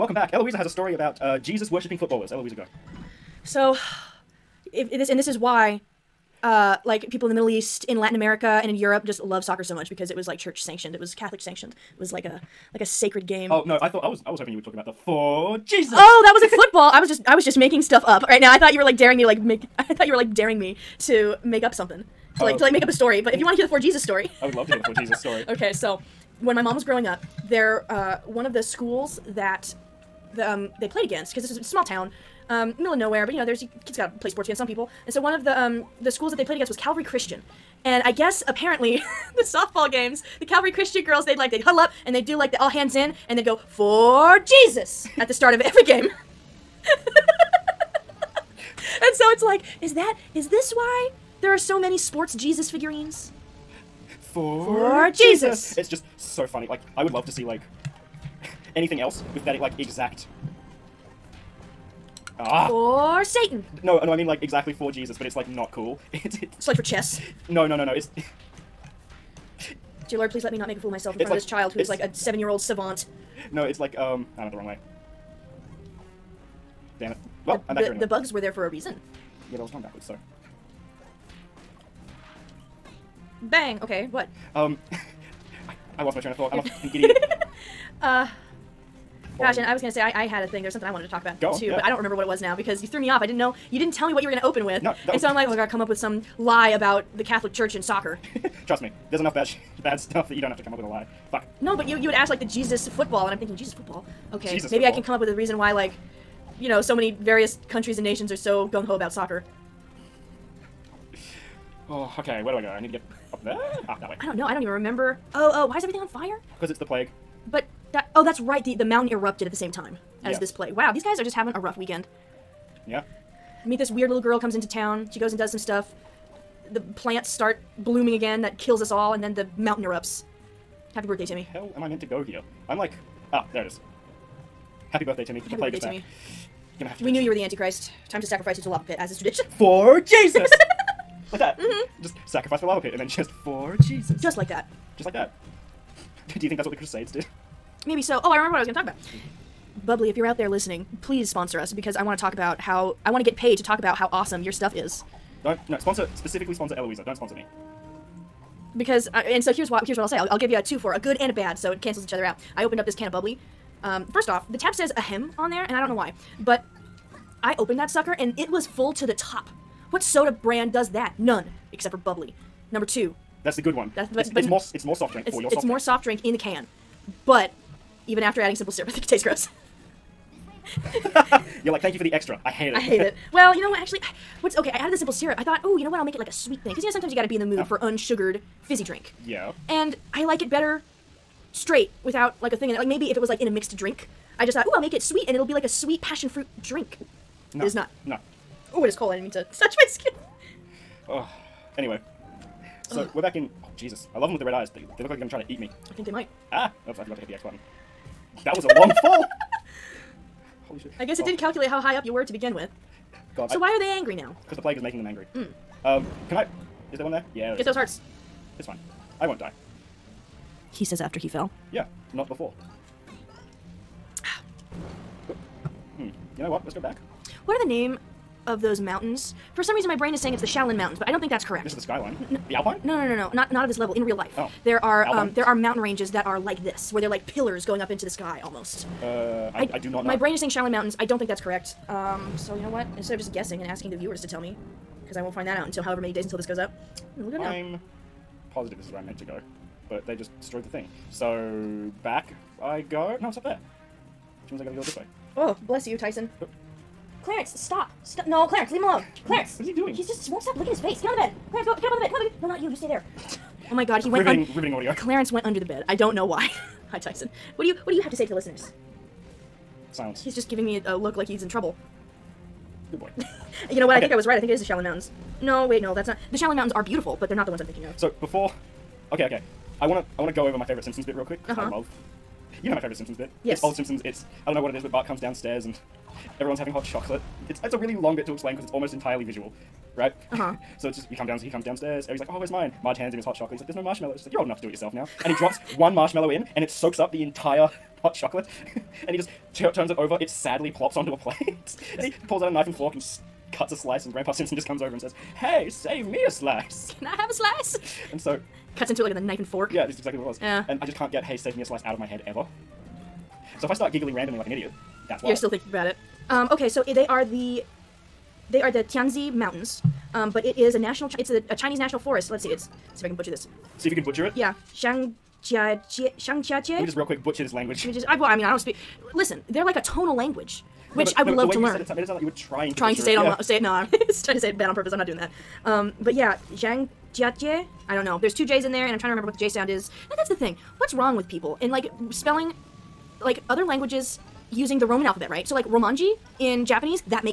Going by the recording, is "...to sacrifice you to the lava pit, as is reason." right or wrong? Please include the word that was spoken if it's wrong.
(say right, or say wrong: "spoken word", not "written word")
wrong: "tradition", not "reason".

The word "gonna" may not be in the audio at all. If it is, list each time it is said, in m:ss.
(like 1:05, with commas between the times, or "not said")
1:29, 1:34, 2:16.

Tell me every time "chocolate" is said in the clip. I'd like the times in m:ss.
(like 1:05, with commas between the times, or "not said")
4:46, 4:53, 4:58.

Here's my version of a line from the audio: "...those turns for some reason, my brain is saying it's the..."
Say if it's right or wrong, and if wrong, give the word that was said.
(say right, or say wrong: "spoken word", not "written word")
wrong: "mountains", not "turns".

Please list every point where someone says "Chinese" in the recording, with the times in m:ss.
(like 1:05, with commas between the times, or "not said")
5:21.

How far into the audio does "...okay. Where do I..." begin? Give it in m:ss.
1:52.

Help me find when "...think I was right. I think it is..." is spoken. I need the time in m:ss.
4:33.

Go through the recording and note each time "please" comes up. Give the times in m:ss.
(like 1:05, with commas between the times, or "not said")
1:10, 2:31.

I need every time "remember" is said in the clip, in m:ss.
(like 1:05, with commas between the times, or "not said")
1:31, 1:54, 2:28, 5:39.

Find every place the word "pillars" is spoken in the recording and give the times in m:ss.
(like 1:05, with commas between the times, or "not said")
3:57.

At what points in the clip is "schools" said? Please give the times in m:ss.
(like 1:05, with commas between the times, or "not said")
0:28, 0:36.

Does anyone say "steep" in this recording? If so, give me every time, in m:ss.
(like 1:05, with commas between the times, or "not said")
not said.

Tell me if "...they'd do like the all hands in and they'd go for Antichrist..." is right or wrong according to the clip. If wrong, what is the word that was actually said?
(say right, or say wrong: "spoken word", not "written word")
wrong: "Jesus", not "Antichrist".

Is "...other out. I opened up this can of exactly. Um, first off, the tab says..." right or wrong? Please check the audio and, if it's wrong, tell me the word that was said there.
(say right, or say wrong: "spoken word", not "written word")
wrong: "bubly", not "exactly".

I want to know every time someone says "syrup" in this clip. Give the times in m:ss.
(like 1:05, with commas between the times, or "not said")
2:58, 3:05.